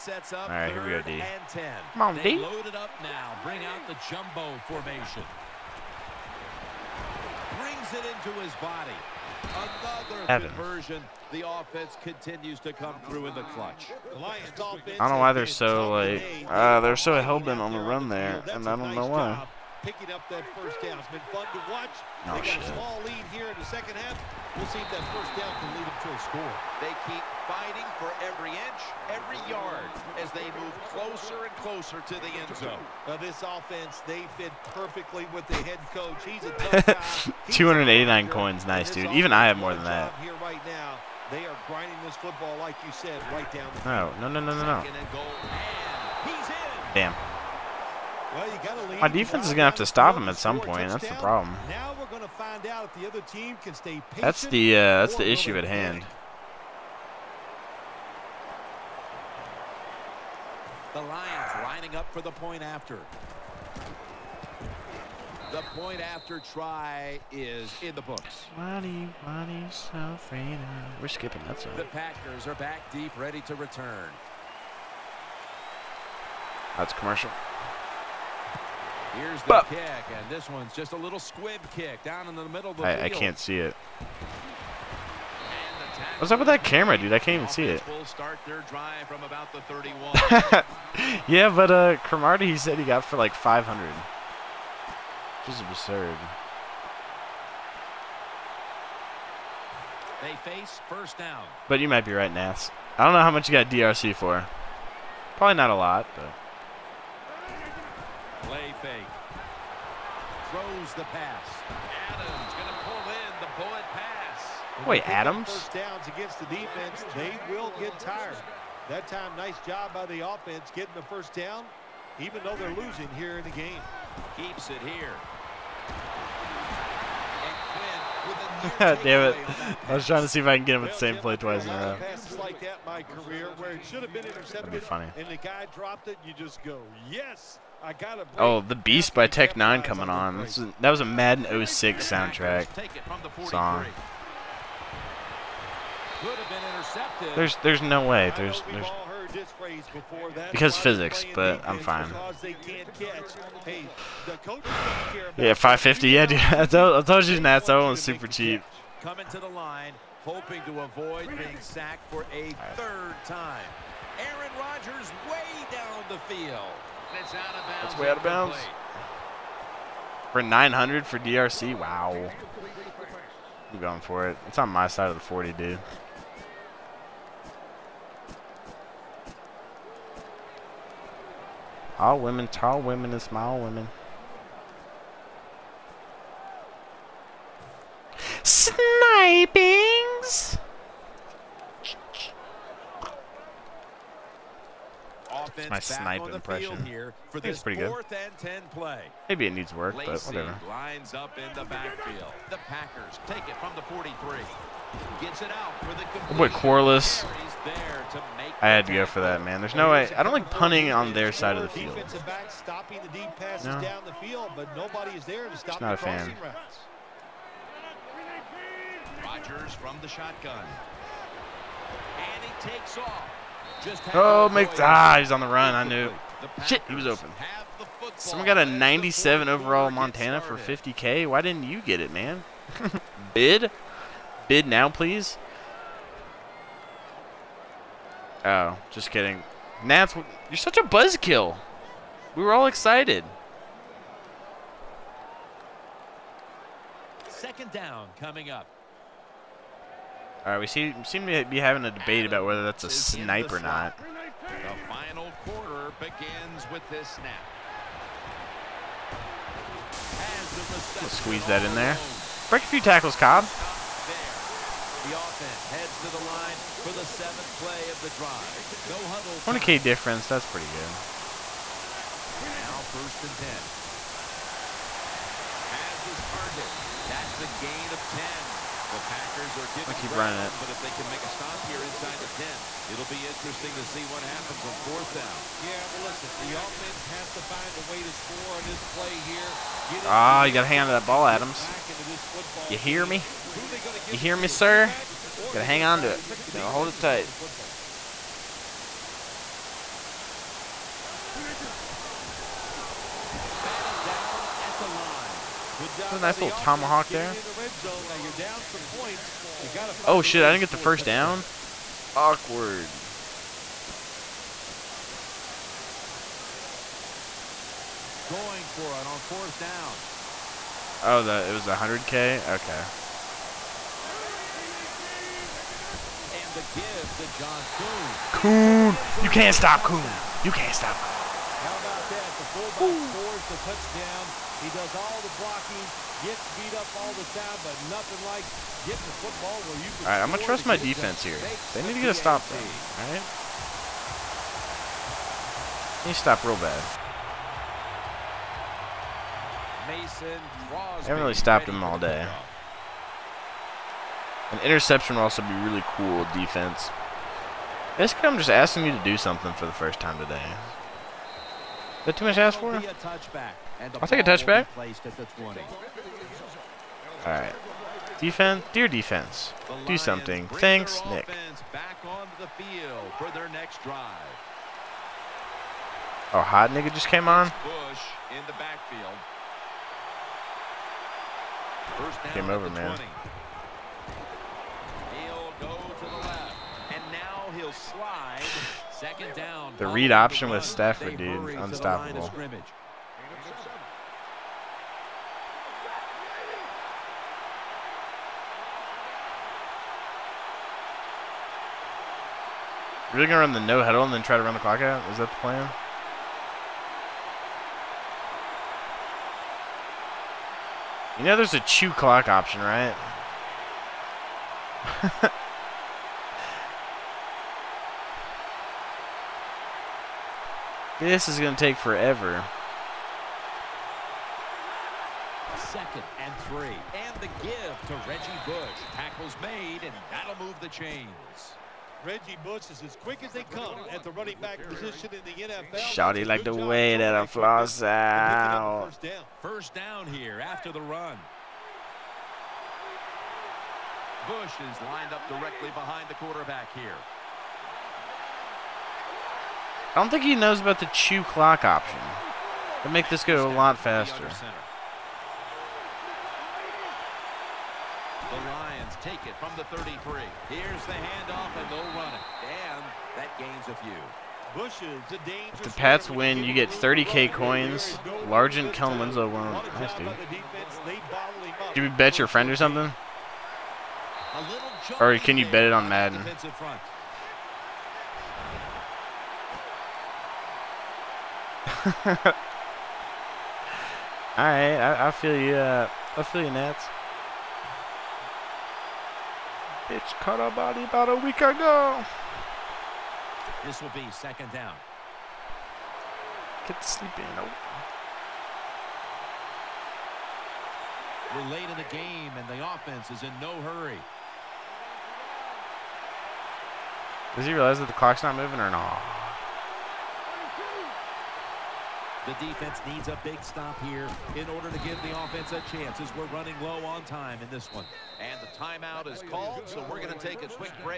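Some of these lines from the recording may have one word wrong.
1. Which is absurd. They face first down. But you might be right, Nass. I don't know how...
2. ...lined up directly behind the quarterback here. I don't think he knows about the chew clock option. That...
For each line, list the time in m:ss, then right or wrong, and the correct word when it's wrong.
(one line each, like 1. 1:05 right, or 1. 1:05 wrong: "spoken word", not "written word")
1. 1:35 right
2. 7:24 right.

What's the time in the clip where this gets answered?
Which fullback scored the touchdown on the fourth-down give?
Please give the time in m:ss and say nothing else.
5:27.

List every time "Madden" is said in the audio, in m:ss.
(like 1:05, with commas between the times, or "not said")
2:21, 7:55.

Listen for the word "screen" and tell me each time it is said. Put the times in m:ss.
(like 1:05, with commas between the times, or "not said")
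not said.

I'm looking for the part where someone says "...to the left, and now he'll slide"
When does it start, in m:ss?
6:25.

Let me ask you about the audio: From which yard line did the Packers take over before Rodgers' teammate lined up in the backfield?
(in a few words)
43.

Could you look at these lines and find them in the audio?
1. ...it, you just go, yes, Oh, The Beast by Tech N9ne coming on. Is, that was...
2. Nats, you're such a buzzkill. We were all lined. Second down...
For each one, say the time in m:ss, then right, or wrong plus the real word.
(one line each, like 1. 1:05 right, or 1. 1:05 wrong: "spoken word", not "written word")
1. 2:16 right
2. 3:59 wrong: "excited", not "lined".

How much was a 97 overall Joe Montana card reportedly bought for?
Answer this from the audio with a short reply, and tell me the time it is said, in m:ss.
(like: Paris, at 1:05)
50K, at 3:50.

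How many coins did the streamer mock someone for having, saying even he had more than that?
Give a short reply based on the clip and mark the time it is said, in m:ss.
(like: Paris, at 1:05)
289, at 0:37.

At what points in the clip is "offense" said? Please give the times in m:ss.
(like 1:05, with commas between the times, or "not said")
0:11, 0:33, 2:00, 4:25, 4:46, 8:22, 8:35.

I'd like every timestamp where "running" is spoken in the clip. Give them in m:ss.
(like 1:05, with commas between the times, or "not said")
4:40, 7:14, 8:36.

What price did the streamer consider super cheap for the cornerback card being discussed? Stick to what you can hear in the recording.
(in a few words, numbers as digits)
550.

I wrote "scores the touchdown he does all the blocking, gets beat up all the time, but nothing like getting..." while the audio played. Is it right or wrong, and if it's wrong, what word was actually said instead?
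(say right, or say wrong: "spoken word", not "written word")
right.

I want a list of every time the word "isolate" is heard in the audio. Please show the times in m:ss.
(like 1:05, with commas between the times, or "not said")
not said.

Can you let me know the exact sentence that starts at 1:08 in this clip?
Money, money, so We're skipping that side.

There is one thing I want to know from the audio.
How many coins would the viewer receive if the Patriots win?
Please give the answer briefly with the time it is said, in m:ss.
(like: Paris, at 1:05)
30k, at 7:46.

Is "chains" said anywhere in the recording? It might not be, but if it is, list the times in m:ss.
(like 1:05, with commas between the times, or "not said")
7:10.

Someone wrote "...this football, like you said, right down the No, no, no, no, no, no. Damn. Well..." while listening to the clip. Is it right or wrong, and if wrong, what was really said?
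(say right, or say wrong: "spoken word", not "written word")
right.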